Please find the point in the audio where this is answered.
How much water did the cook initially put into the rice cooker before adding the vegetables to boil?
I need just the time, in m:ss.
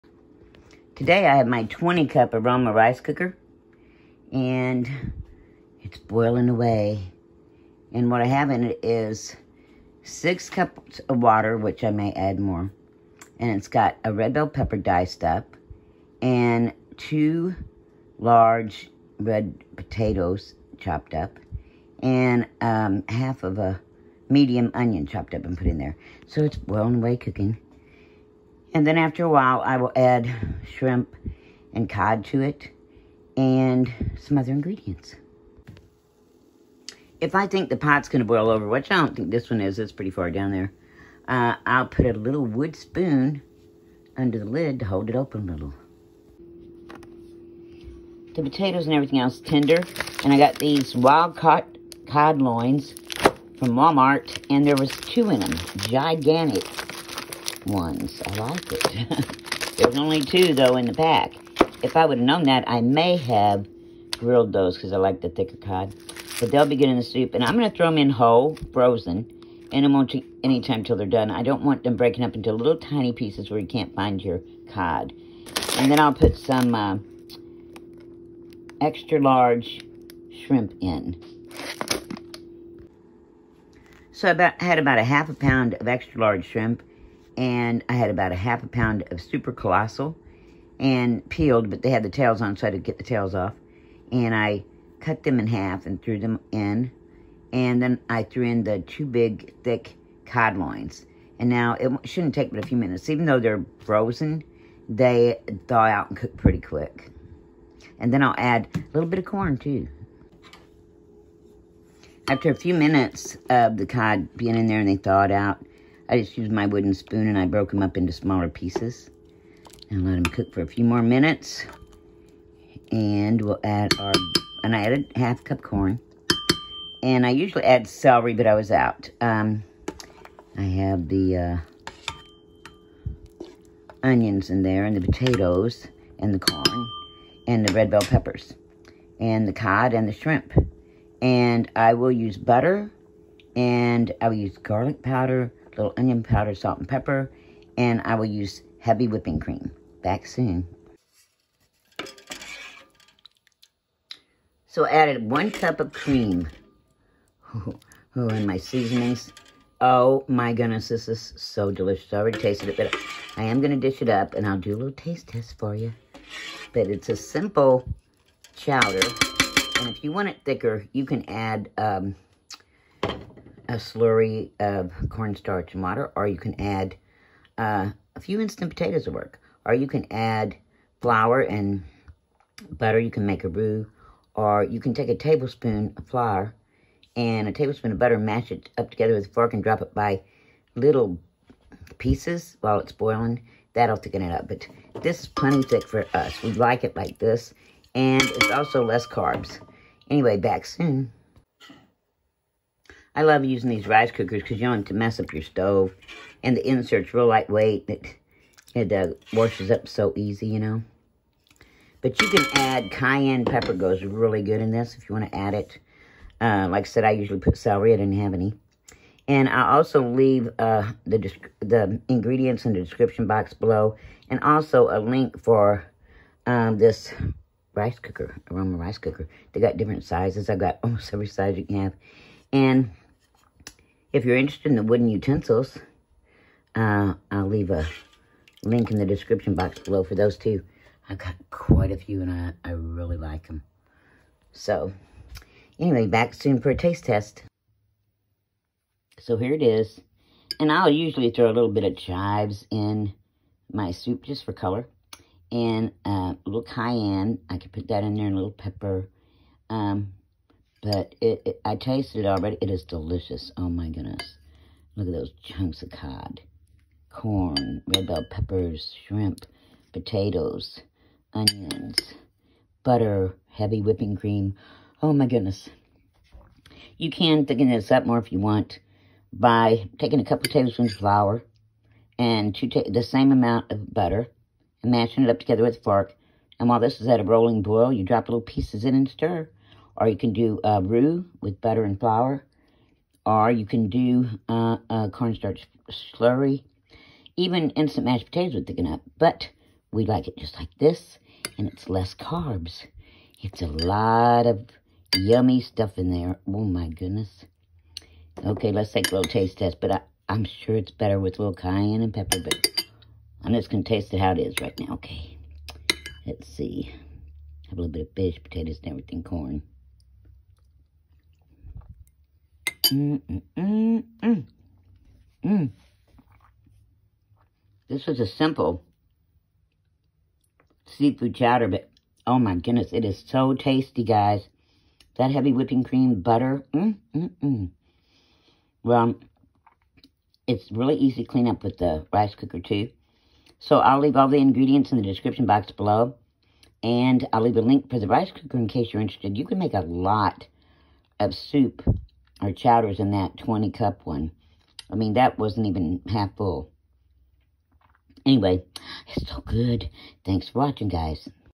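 0:10.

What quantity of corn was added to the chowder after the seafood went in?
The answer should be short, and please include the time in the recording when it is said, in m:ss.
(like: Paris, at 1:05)
half cup, at 2:05.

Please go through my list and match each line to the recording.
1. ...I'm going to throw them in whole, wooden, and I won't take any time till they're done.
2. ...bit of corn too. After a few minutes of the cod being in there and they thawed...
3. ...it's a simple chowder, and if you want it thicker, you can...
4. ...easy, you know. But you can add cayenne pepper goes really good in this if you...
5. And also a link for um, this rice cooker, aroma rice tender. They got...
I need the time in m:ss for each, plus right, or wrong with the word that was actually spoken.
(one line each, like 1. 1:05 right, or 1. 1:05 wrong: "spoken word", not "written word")
1. 1:07 wrong: "frozen", not "wooden"
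2. 1:49 right
3. 2:46 right
4. 3:30 right
5. 3:44 wrong: "cooker", not "tender".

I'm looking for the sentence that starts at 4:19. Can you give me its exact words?
Um, but it, it, I tasted it already.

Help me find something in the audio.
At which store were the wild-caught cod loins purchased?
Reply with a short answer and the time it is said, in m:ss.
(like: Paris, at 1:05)
Walmart, at 0:53.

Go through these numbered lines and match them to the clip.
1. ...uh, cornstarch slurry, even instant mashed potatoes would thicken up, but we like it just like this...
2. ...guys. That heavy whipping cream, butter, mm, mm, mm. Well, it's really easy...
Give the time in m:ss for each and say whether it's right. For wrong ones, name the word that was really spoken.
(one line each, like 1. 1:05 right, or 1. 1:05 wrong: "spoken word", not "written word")
1. 4:54 right
2. 5:34 right.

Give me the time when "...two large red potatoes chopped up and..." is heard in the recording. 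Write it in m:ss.
0:16.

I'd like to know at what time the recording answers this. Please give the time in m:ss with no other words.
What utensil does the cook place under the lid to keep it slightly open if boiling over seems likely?
0:42.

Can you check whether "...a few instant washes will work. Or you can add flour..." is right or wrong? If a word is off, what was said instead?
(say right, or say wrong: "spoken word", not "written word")
wrong: "potatoes", not "washes".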